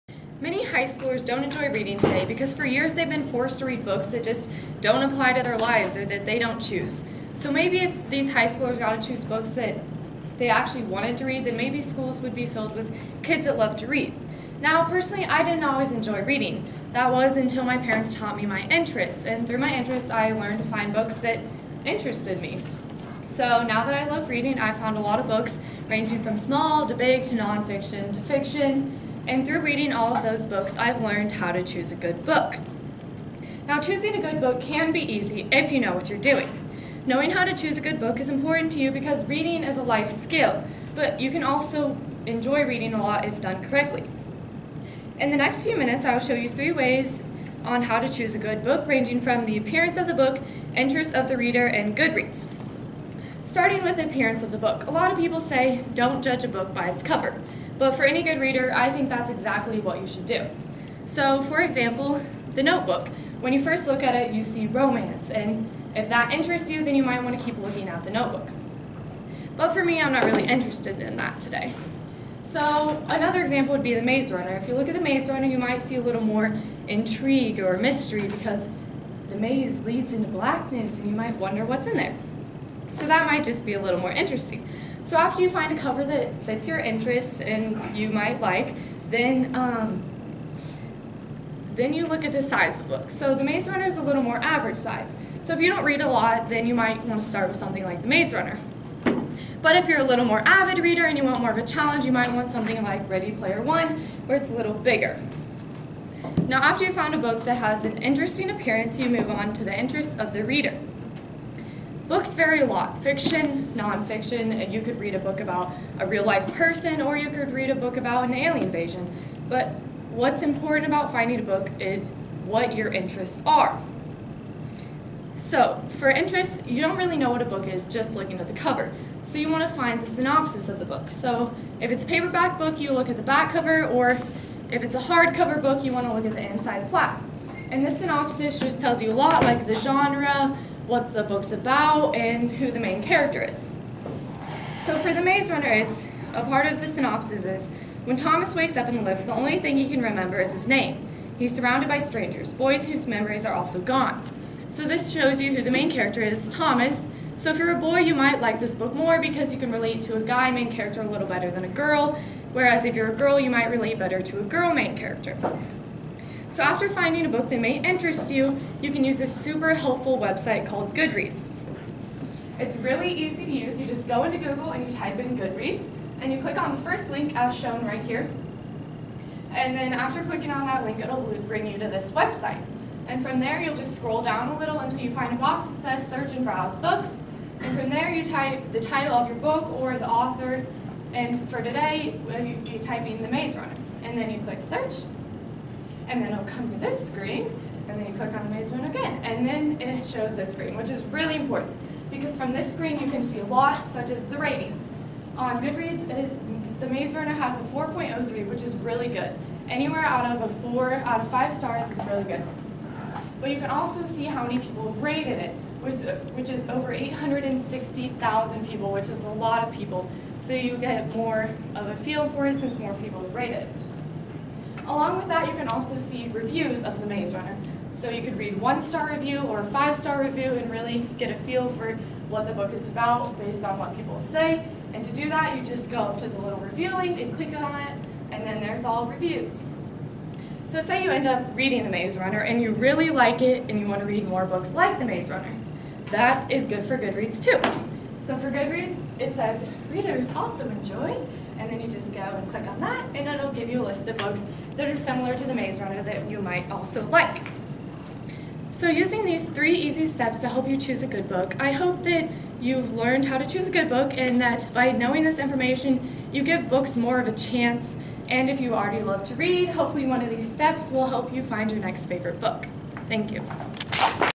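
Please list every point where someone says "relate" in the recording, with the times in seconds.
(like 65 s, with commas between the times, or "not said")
159 s, 163 s.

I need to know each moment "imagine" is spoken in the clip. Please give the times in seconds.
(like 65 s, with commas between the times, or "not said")
not said.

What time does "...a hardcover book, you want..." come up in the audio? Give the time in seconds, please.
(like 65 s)
134 s.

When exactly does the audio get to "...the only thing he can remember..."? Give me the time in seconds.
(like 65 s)
149 s.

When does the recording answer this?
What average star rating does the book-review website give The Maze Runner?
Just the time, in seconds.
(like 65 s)
207 s.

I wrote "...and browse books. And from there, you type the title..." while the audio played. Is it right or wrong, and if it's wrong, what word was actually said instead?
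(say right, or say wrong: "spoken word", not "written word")
right.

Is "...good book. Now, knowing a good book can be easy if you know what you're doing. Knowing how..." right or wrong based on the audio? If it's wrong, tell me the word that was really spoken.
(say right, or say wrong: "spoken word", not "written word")
wrong: "choosing", not "knowing".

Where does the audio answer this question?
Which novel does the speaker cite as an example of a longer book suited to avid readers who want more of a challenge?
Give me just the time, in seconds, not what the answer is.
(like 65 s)
103 s.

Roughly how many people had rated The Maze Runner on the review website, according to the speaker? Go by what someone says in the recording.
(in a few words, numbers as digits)
Over 860,000.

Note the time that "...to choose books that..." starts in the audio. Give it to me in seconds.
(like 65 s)
8 s.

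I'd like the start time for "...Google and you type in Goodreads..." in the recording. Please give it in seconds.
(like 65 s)
174 s.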